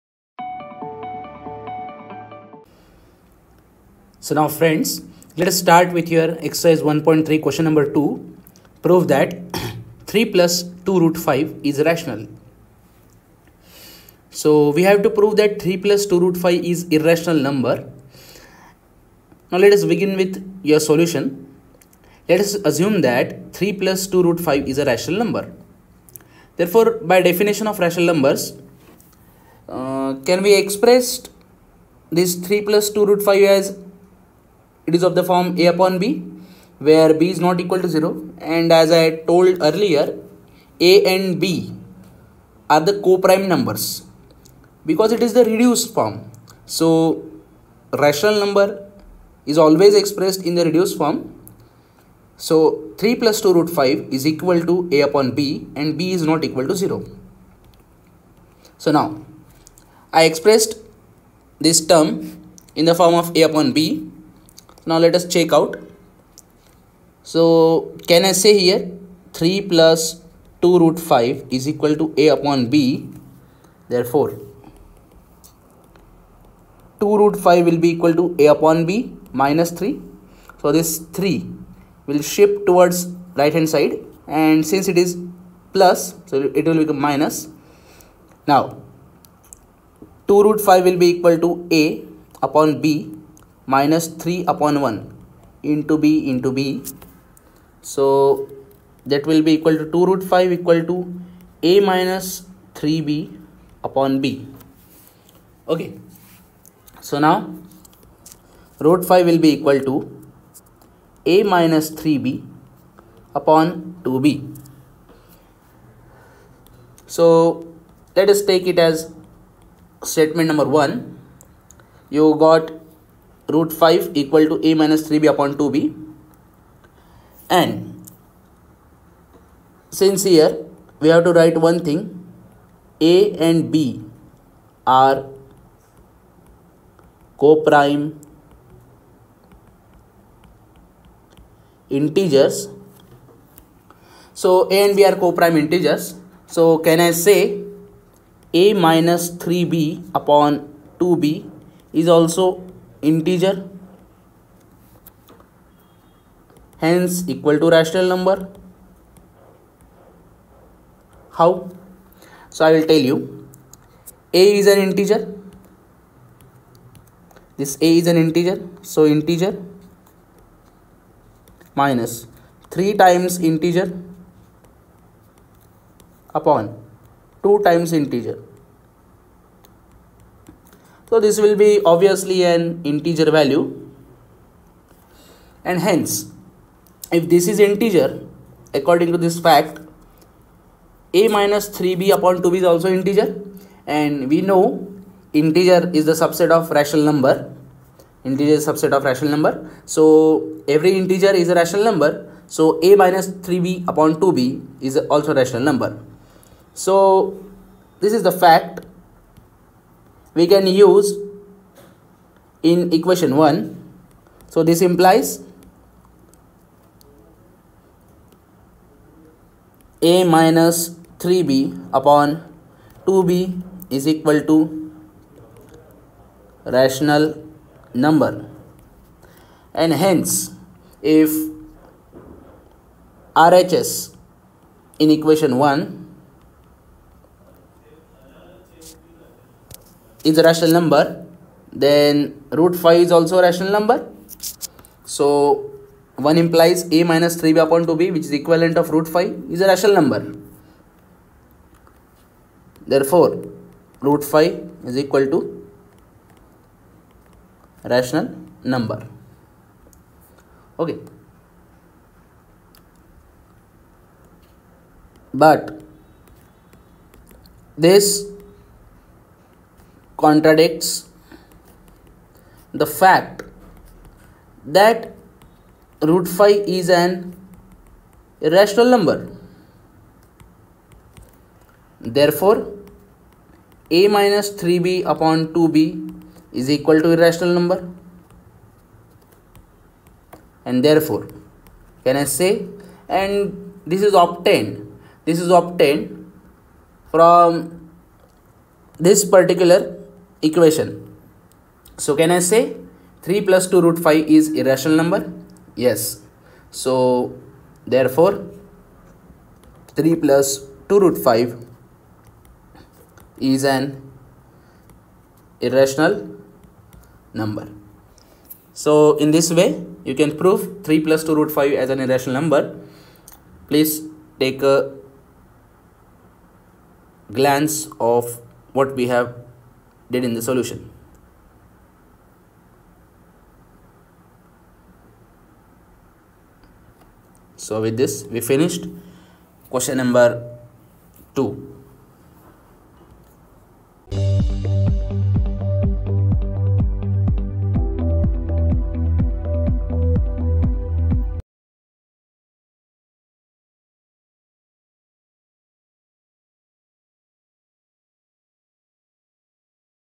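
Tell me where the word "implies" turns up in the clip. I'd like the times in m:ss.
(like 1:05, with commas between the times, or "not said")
3:34, 4:06.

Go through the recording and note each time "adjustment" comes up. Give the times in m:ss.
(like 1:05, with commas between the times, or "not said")
not said.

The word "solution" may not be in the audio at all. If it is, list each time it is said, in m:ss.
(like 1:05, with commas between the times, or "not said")
0:20, 5:30.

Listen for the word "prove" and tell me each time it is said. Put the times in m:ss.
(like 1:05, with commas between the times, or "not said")
0:08, 0:15, 5:20.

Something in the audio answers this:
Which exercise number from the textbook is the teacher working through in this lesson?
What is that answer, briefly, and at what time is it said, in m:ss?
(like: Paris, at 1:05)
1.3, at 0:06.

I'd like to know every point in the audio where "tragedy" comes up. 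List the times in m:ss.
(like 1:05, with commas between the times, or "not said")
not said.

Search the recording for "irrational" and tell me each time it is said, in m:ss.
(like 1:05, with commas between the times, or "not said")
0:16, 4:38, 4:47, 5:04, 5:15, 5:21.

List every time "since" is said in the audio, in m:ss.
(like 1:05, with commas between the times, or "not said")
1:24, 2:09.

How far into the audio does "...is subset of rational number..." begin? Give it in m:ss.
3:18.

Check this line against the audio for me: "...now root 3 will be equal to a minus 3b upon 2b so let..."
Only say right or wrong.
wrong.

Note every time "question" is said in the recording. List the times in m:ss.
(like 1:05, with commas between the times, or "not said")
0:07, 5:39.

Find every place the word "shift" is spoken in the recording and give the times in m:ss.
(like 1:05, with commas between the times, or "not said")
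1:22.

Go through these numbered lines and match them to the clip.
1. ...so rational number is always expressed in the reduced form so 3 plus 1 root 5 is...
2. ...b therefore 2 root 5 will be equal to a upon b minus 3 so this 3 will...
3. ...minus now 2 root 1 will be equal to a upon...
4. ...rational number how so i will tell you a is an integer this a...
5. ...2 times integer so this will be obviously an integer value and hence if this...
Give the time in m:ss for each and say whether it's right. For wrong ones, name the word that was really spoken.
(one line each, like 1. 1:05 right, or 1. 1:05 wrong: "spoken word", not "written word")
1. 0:46 wrong: "2", not "1"
2. 1:12 right
3. 1:26 wrong: "5", not "1"
4. 2:37 right
5. 2:57 right.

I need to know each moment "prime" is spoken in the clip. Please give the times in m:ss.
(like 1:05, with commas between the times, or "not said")
0:43, 2:17, 2:25.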